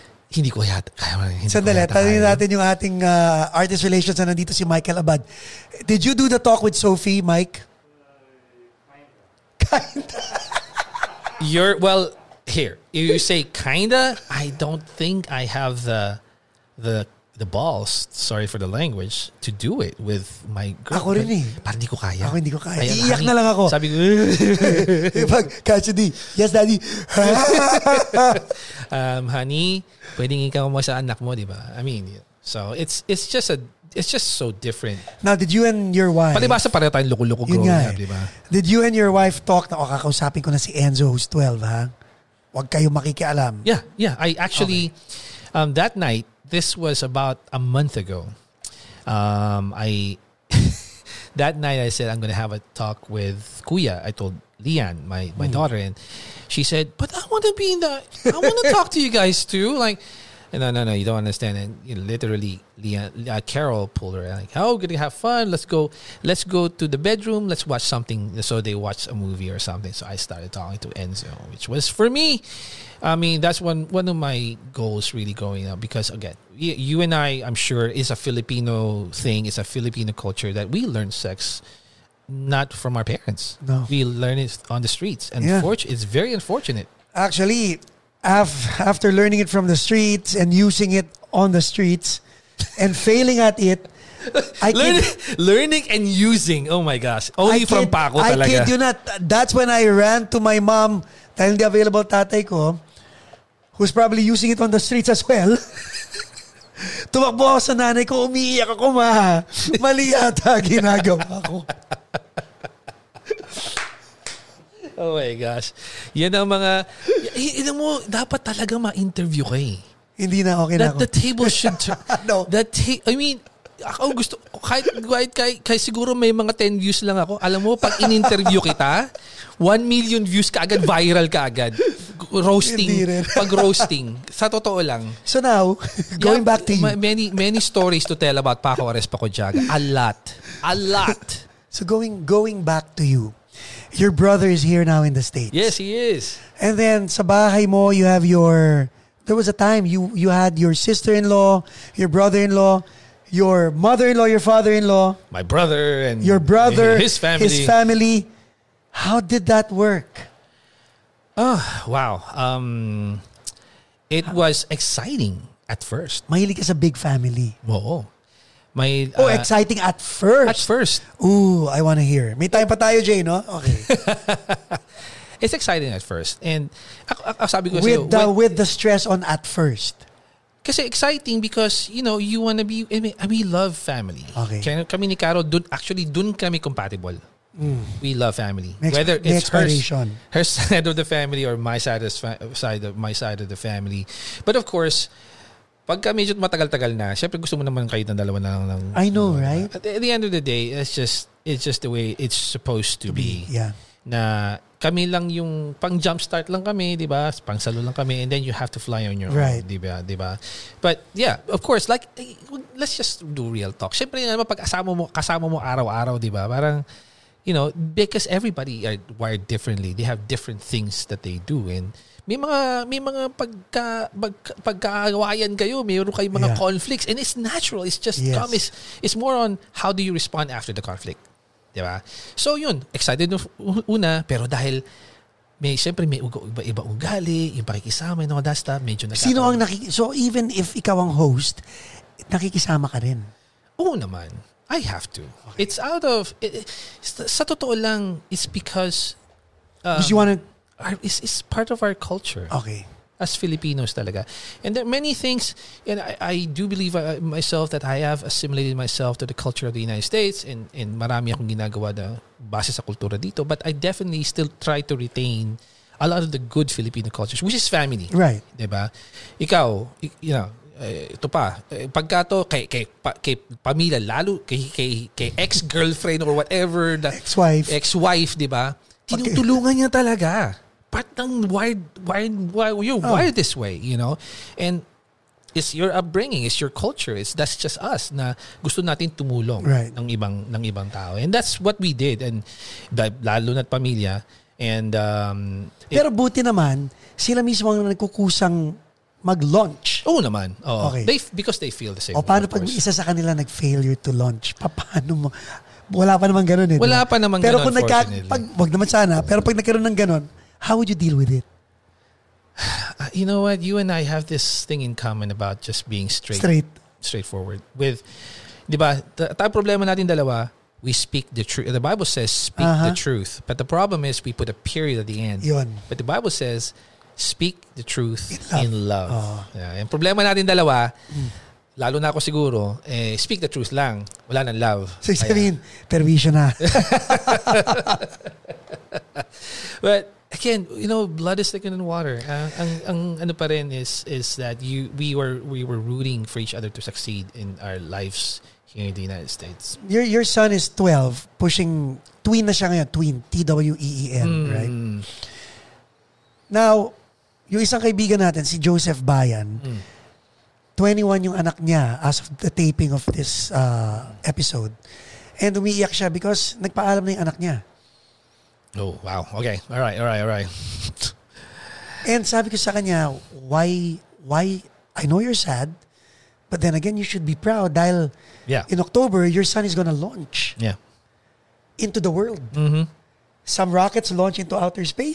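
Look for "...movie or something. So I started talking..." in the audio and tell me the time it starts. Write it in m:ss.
1:09.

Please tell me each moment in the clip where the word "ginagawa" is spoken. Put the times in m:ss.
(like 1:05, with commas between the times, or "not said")
1:50, 4:21.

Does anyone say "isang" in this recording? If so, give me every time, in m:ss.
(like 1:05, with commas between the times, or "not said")
5:57.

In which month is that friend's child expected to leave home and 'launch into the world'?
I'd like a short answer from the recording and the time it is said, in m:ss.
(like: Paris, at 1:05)
October, at 6:18.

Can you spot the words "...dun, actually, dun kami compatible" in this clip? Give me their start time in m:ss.
3:05.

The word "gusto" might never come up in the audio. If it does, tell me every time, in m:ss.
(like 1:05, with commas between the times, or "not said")
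2:04, 3:17, 4:48.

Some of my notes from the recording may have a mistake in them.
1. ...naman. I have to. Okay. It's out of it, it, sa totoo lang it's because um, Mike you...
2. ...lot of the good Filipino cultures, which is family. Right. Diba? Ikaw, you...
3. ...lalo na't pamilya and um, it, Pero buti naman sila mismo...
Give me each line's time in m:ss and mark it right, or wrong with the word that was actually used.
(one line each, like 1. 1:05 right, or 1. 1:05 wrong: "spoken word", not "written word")
1. 4:03 wrong: "Because", not "Mike"
2. 4:26 right
3. 4:53 right.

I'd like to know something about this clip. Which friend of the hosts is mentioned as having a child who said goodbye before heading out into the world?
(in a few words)
Joseph Bayan.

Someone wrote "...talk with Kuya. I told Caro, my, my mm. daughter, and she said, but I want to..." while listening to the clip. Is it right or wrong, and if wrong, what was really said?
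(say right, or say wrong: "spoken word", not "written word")
wrong: "Lian", not "Caro".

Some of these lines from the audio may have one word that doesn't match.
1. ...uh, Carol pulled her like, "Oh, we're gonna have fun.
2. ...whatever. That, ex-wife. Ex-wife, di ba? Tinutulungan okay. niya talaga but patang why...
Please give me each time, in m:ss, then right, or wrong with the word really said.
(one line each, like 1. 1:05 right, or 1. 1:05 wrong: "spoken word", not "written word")
1. 1:03 right
2. 4:36 right.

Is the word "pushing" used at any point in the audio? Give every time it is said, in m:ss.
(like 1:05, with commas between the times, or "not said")
5:51.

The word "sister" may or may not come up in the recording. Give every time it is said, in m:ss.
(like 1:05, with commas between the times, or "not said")
2:30.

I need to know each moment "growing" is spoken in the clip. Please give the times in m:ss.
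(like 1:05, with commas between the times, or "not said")
0:37.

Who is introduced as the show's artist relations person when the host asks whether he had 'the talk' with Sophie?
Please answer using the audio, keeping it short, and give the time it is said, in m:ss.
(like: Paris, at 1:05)
Michael Abad, at 0:04.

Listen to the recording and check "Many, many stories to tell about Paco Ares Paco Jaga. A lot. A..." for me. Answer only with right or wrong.
right.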